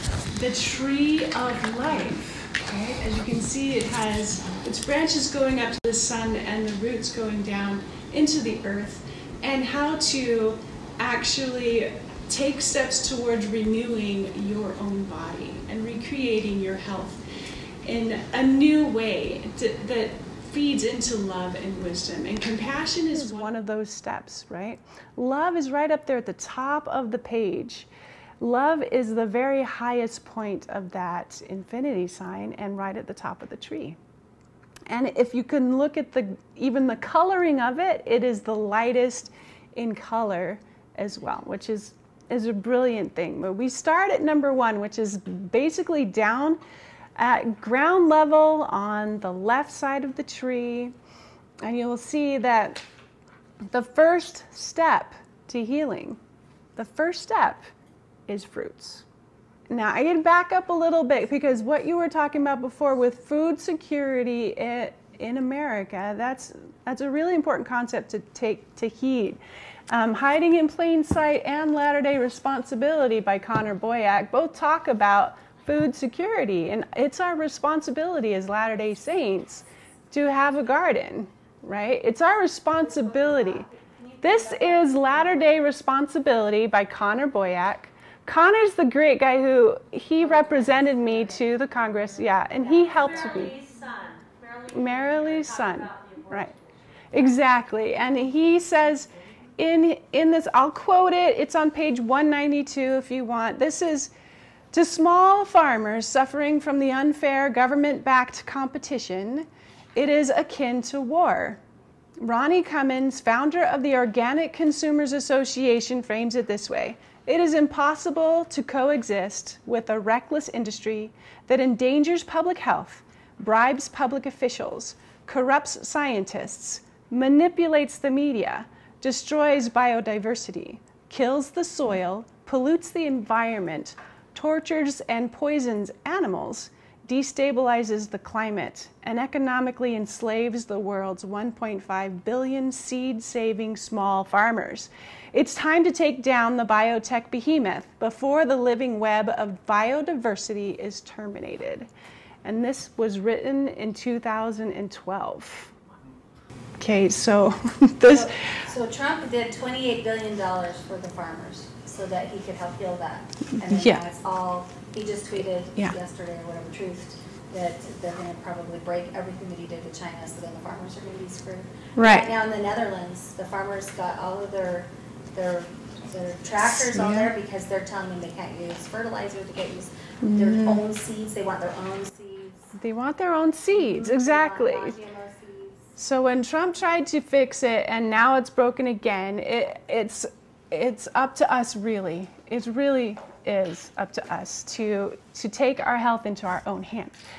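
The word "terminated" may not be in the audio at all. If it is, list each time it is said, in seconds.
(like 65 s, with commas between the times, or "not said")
151 s.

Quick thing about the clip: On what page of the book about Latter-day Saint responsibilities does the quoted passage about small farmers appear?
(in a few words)
192.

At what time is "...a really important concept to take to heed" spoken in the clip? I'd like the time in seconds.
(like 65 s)
67 s.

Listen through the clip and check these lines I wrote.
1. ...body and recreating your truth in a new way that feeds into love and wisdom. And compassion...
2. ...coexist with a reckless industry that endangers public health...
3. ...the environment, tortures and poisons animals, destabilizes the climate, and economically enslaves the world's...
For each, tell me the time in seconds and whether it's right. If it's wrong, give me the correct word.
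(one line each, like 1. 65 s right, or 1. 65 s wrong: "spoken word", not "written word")
1. 15 s wrong: "health", not "truth"
2. 118 s right
3. 132 s right.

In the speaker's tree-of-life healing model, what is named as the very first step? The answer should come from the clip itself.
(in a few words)
Fruits.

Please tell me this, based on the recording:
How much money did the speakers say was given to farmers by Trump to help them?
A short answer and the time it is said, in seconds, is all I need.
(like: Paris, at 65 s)
$28 billion, at 159 s.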